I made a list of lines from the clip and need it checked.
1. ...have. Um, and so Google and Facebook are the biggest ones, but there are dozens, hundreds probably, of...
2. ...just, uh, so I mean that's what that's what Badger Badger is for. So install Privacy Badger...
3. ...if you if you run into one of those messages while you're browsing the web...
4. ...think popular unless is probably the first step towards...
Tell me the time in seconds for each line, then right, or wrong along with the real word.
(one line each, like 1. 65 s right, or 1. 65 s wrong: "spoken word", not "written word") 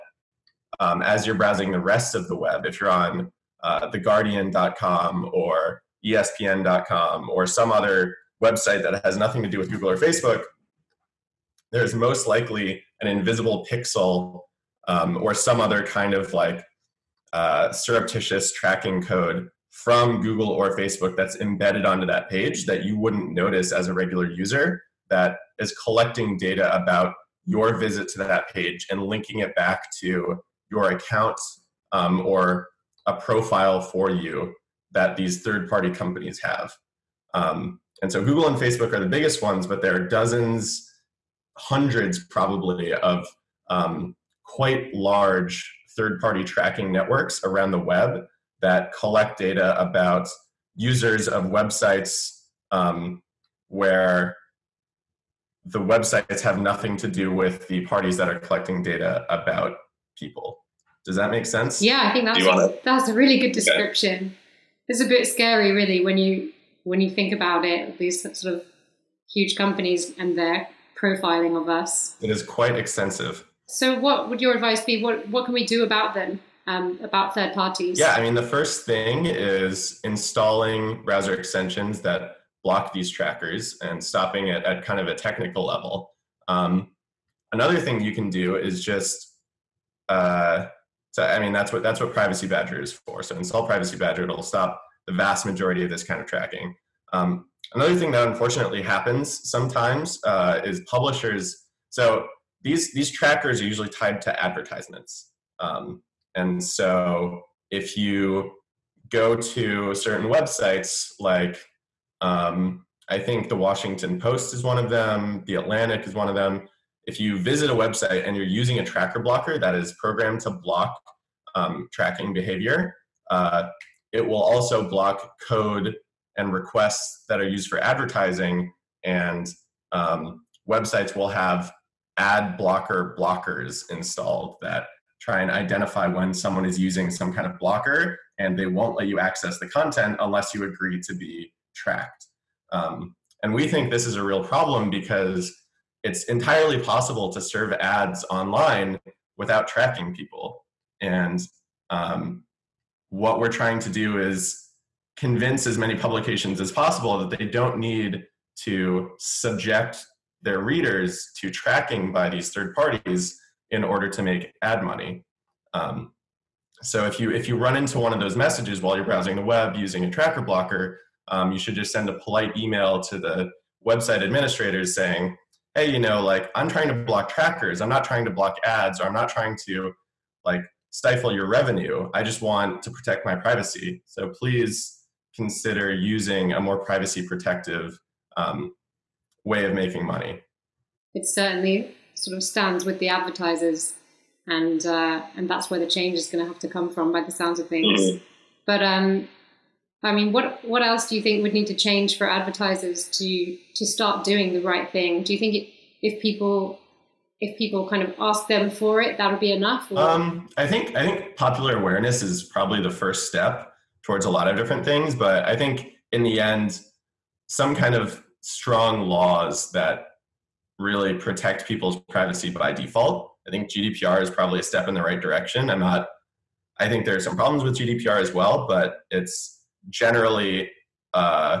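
1. 36 s right
2. 88 s wrong: "Privacy", not "Badger"
3. 167 s right
4. 211 s wrong: "awareness", not "unless".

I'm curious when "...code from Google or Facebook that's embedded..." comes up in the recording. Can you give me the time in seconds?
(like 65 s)
19 s.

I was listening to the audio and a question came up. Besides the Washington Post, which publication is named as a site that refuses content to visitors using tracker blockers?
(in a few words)
The Atlantic.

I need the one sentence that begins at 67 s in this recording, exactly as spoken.
These sort of huge companies and their profiling of us.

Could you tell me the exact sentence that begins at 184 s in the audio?
So please consider using a more privacy protective um, way of making money.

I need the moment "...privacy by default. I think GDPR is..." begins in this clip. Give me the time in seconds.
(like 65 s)
222 s.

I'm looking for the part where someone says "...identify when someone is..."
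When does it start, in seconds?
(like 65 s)
135 s.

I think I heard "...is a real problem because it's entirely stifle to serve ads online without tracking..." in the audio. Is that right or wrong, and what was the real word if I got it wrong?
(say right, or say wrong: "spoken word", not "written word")
wrong: "possible", not "stifle".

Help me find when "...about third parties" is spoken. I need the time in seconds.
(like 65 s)
77 s.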